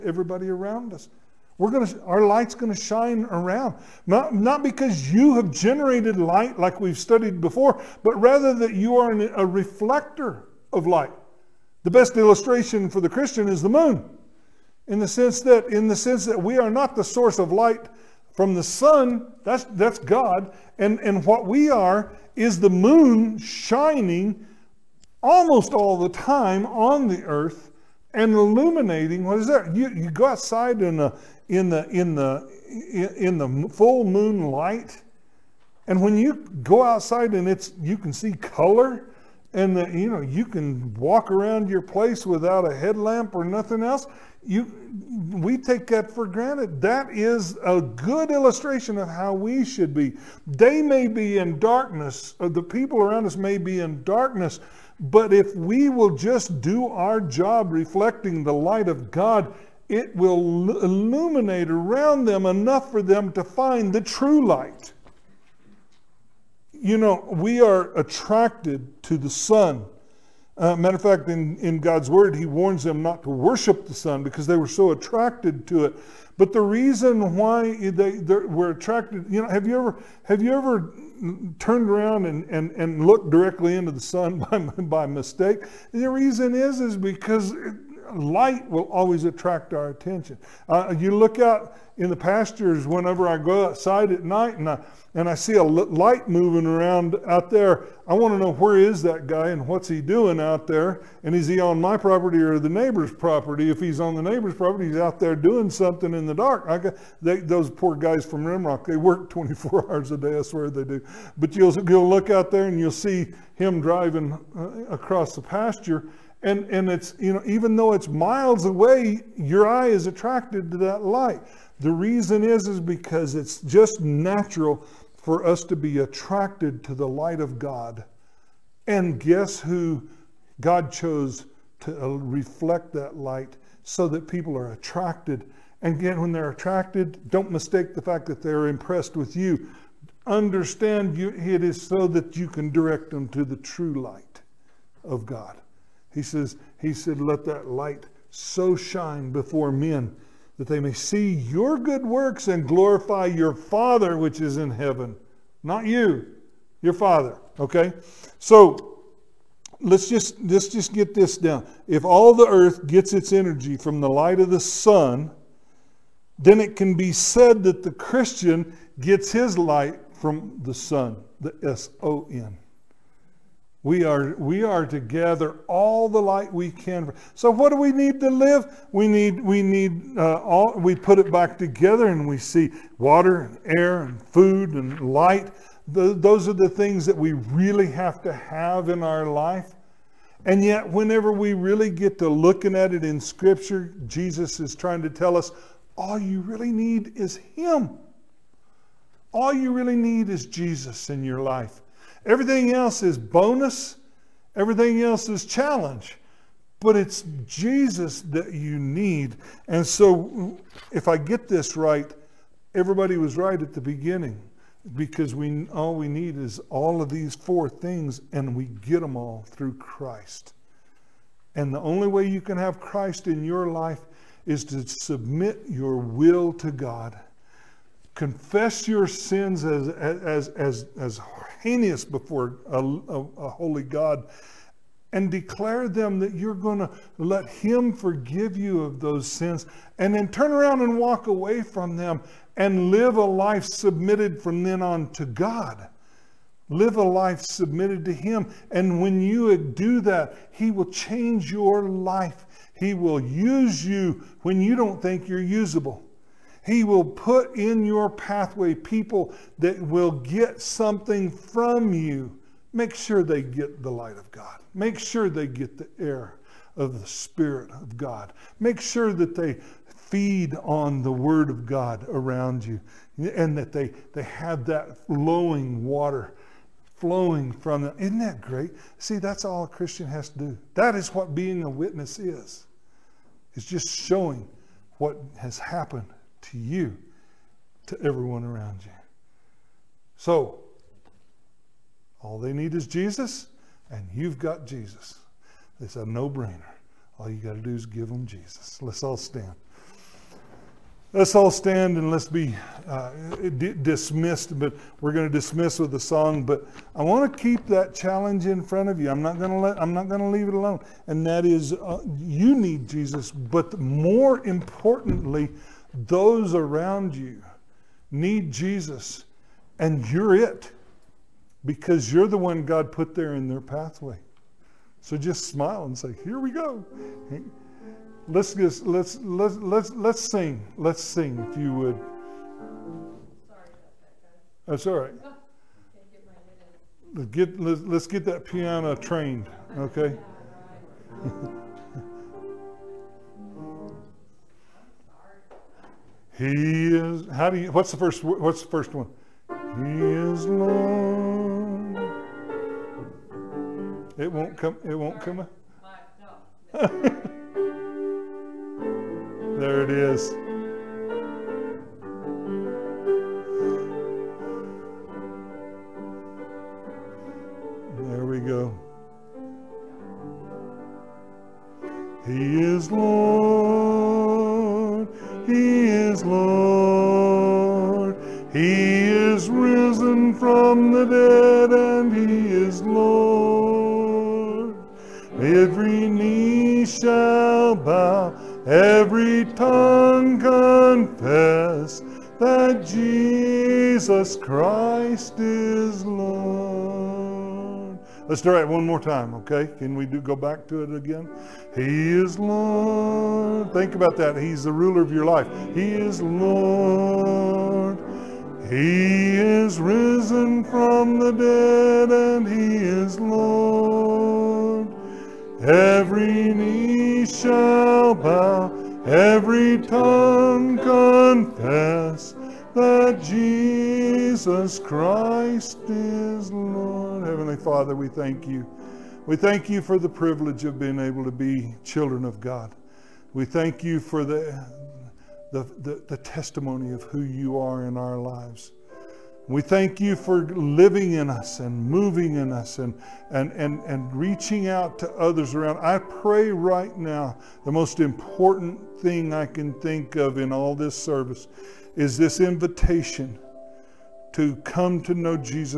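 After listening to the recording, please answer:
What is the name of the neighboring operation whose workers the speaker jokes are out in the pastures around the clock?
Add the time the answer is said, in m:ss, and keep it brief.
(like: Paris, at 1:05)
Rimrock, at 1:48.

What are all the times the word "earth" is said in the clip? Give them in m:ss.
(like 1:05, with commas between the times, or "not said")
0:27, 2:42.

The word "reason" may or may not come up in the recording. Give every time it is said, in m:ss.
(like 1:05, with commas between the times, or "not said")
1:16, 1:26, 2:01.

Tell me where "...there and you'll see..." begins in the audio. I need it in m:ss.
1:52.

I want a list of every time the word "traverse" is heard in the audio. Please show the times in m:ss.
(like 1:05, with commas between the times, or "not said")
not said.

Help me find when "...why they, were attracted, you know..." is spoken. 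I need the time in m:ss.
1:17.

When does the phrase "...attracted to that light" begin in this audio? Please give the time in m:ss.
2:00.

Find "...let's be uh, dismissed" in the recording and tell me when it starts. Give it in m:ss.
5:02.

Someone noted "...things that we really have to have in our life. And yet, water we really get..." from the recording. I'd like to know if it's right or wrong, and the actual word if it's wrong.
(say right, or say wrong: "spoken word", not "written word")
wrong: "whenever", not "water".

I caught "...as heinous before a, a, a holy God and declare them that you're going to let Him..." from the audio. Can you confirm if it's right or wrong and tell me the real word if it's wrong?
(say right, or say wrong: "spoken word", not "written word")
right.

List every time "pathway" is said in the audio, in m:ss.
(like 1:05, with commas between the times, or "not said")
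4:18, 5:23.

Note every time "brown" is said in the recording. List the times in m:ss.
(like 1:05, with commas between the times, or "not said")
not said.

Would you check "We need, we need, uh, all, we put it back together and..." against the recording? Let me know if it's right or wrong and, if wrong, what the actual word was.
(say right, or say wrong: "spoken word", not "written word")
right.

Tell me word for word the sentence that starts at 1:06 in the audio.
You know, we are attracted to the sun.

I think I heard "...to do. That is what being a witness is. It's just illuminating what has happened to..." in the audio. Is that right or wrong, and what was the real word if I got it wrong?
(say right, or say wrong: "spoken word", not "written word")
wrong: "showing", not "illuminating".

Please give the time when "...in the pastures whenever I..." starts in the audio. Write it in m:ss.
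1:31.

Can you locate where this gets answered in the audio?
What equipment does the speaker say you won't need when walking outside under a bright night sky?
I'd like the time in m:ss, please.
0:42.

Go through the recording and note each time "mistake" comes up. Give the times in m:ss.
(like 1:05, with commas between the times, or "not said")
1:25, 2:17.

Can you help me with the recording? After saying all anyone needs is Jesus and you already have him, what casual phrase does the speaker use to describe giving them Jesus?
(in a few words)
A no brainer.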